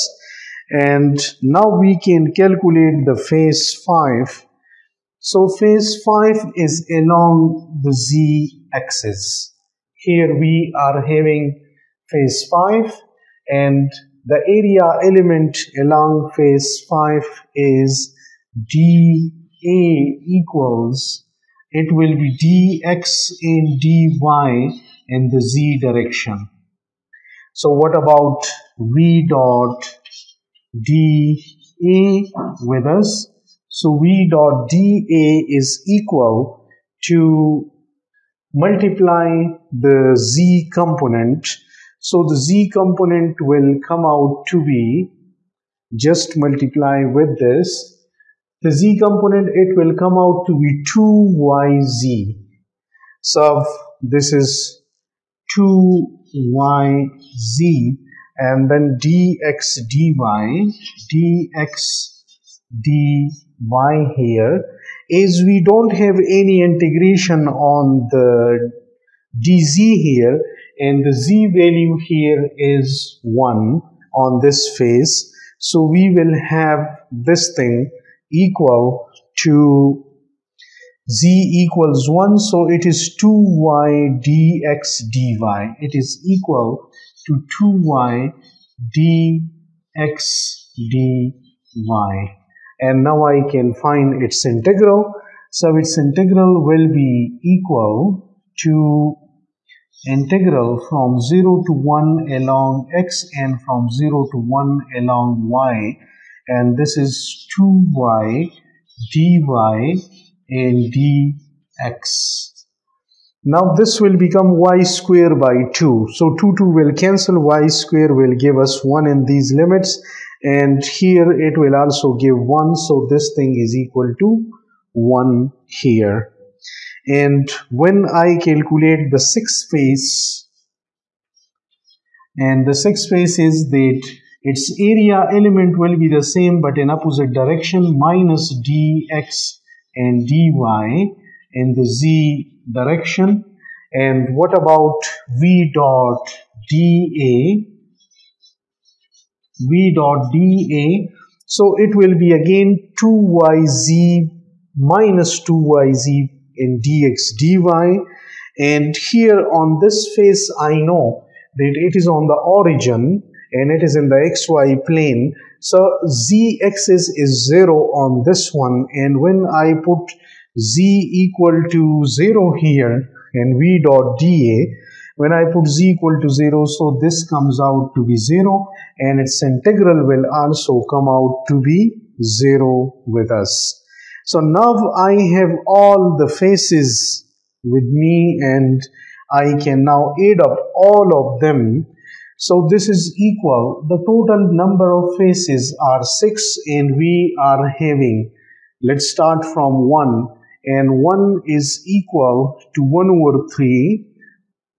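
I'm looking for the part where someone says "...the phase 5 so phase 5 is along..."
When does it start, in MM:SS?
00:03.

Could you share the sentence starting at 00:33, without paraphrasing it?
So V dot dA is equal to multiply the Z component.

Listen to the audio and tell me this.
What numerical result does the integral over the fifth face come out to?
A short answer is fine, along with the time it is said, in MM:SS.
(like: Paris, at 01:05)
1, at 02:03.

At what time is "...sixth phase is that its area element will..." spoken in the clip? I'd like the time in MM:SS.
02:12.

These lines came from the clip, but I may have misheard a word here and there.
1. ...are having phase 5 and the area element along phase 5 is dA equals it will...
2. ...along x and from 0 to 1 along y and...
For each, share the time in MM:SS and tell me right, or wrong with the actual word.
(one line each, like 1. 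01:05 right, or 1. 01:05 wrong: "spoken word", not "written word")
1. 00:10 right
2. 01:42 right.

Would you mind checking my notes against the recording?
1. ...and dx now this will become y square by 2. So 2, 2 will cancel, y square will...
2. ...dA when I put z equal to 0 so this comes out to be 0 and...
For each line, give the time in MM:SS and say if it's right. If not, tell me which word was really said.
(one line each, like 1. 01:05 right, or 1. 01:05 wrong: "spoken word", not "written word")
1. 01:50 right
2. 02:54 right.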